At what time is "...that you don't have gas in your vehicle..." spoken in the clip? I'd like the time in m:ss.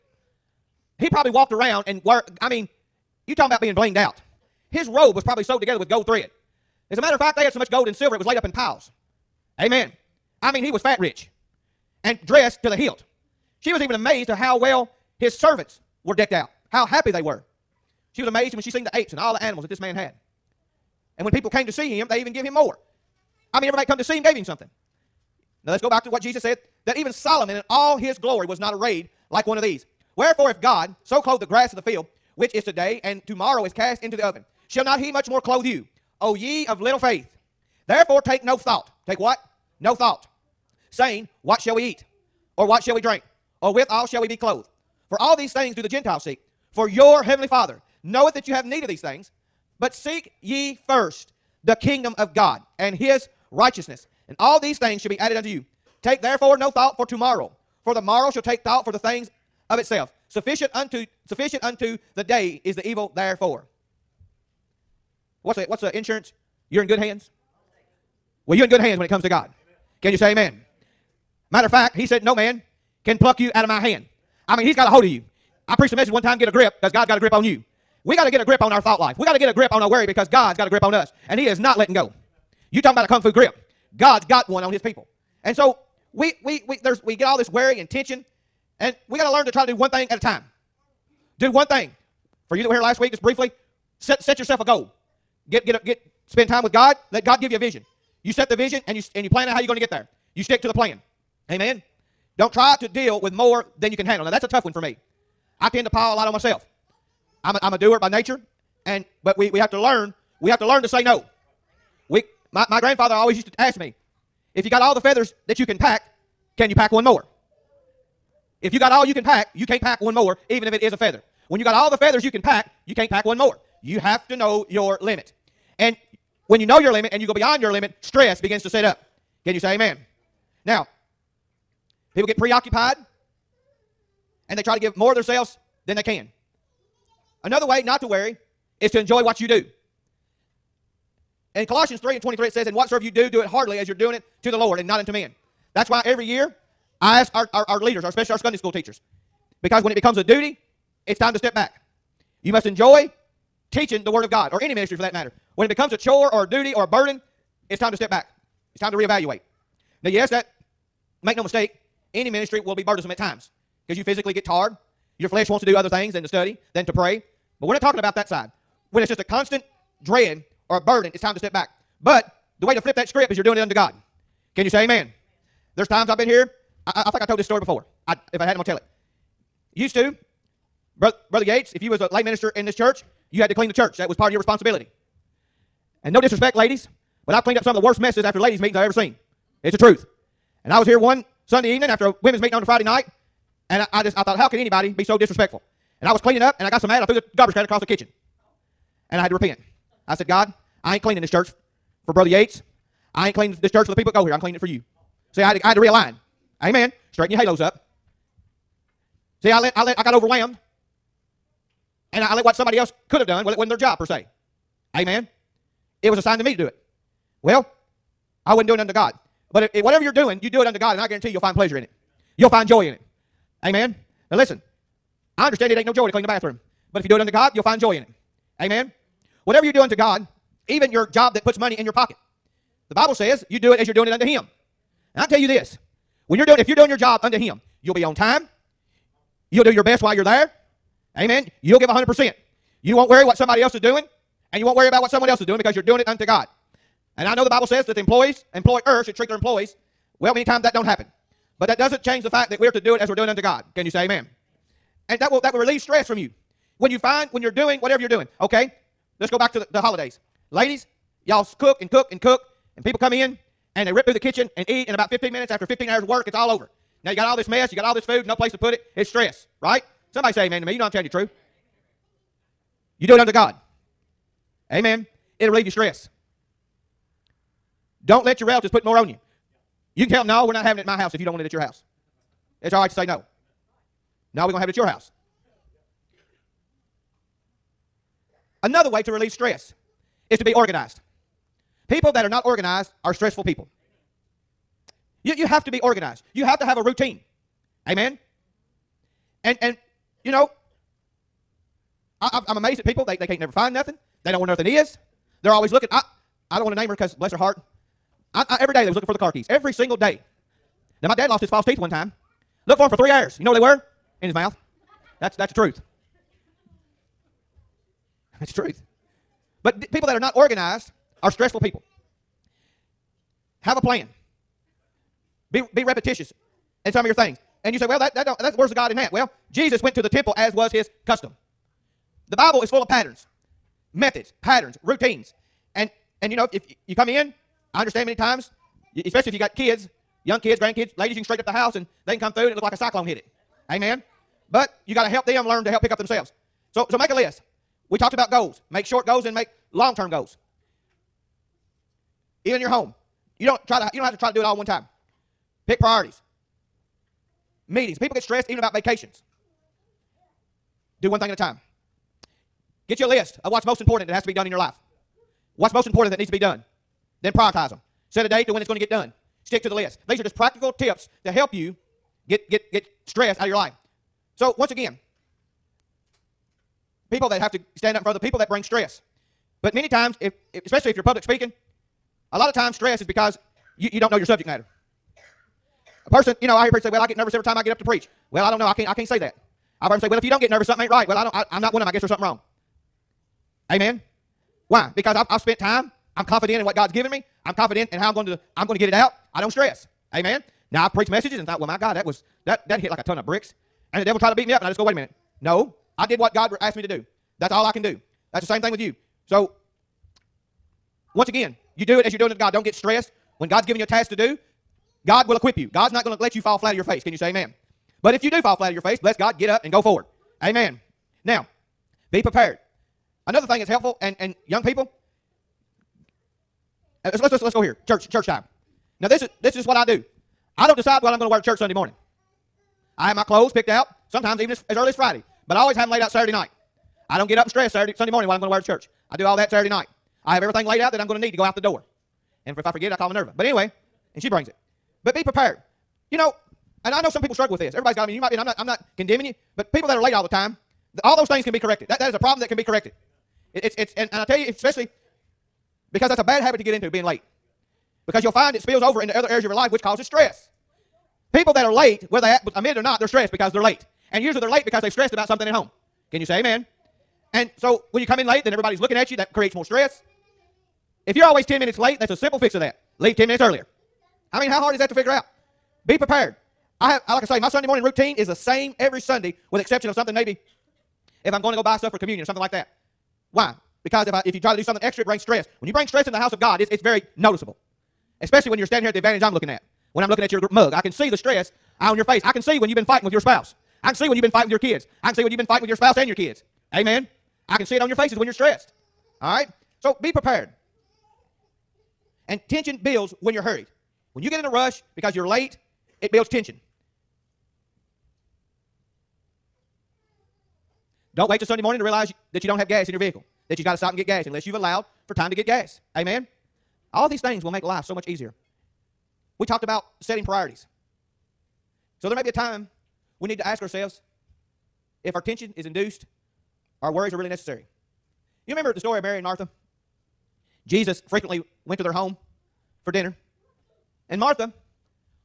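8:32.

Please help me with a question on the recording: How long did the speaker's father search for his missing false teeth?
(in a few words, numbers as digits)
3 hours.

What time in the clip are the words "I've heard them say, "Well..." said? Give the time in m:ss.
6:29.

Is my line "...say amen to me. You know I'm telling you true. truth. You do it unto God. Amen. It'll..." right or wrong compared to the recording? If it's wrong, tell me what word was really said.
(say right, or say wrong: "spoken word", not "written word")
right.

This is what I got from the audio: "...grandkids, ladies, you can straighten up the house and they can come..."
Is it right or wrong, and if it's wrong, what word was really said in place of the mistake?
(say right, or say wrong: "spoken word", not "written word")
right.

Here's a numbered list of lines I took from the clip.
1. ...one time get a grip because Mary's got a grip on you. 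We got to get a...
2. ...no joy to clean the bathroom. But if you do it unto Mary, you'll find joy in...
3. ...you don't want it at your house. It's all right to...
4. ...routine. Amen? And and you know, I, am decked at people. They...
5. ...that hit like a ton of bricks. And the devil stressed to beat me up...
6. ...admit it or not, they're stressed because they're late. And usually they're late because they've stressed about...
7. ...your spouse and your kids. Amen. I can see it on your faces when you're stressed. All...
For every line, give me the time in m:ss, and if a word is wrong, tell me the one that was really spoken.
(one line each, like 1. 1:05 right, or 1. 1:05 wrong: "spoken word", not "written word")
1. 1:16 wrong: "God", not "Mary"
2. 3:45 wrong: "God", not "Mary"
3. 4:41 right
4. 4:56 wrong: "amazed", not "decked"
5. 6:42 wrong: "tried", not "stressed"
6. 7:42 right
7. 8:15 right.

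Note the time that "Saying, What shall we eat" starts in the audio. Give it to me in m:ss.
0:40.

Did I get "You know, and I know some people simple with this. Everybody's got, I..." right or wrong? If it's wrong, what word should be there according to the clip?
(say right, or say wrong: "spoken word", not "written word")
wrong: "struggle", not "simple".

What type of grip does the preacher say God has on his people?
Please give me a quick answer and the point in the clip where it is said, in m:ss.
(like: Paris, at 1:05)
kung fu grip, at 1:23.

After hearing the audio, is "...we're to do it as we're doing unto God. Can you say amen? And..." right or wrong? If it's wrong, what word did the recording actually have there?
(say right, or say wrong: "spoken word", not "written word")
right.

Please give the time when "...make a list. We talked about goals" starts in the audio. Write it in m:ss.
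5:46.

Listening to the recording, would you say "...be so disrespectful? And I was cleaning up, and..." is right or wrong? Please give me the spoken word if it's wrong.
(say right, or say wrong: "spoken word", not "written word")
right.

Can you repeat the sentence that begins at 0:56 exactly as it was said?
Take therefore no thought for tomorrow, for the morrow shall take thought for the things of itself.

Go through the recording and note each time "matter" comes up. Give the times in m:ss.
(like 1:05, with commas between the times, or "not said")
0:06, 1:11, 2:35, 6:24.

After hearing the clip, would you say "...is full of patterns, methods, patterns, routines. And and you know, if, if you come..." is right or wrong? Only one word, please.
right.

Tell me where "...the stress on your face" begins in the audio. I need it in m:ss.
8:11.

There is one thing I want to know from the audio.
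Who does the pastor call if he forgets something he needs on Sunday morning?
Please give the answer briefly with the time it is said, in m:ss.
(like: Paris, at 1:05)
Minerva, at 7:23.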